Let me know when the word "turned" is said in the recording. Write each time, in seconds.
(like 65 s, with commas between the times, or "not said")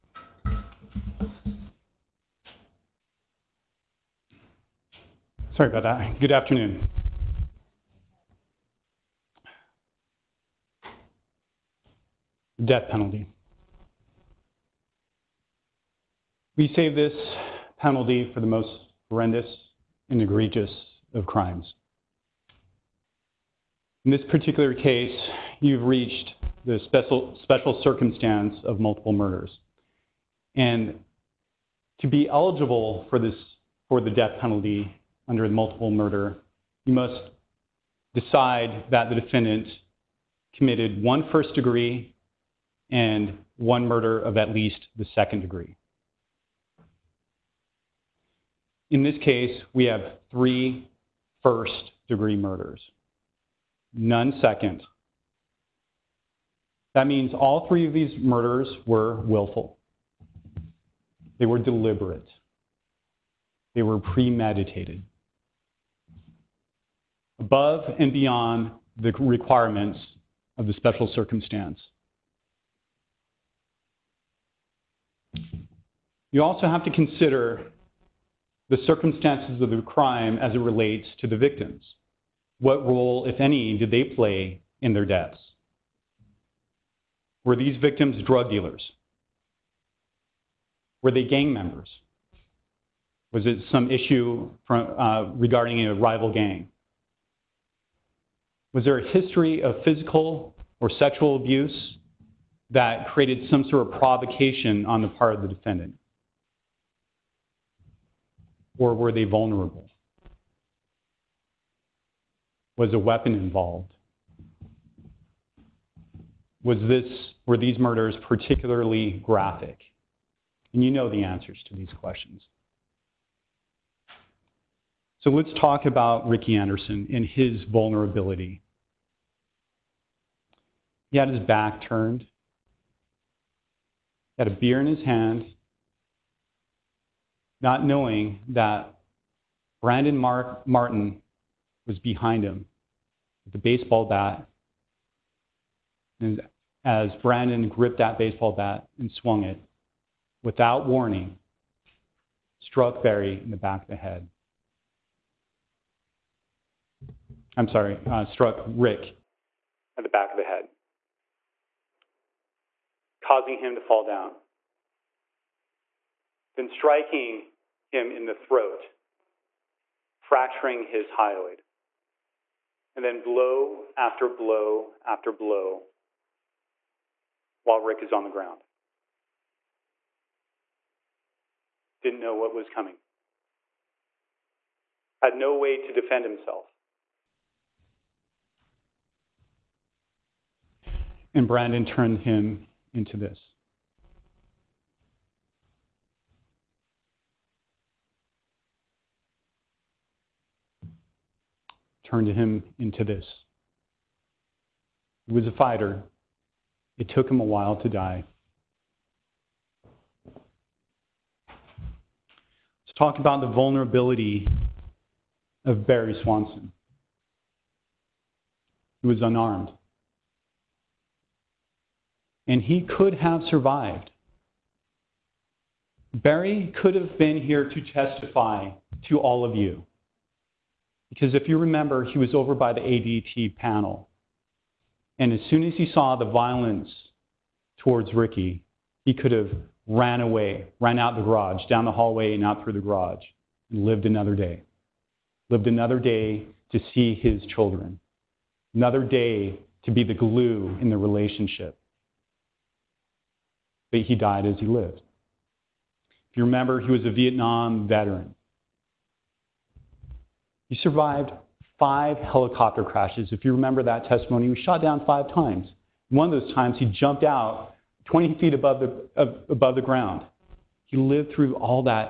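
131 s, 191 s, 202 s.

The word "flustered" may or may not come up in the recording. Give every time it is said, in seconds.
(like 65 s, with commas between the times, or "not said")
not said.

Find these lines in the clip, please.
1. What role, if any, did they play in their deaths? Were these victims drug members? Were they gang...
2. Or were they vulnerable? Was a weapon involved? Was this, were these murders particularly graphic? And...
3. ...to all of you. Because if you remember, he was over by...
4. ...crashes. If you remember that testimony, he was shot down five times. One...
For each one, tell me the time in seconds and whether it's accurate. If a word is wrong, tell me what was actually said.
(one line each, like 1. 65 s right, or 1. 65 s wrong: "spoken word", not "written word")
1. 82 s wrong: "dealers", not "members"
2. 108 s right
3. 229 s right
4. 262 s right.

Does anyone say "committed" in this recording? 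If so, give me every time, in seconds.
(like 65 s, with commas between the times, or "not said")
40 s.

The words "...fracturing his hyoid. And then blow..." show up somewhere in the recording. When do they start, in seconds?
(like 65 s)
170 s.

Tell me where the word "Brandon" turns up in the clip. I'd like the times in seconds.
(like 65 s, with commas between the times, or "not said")
139 s, 147 s, 191 s.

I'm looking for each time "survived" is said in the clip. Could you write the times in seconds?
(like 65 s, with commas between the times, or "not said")
223 s, 260 s.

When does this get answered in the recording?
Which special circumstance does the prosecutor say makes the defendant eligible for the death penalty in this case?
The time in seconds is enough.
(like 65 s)
28 s.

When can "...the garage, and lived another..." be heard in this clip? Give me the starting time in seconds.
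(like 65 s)
242 s.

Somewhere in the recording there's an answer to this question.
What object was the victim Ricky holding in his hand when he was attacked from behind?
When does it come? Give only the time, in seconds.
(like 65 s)
134 s.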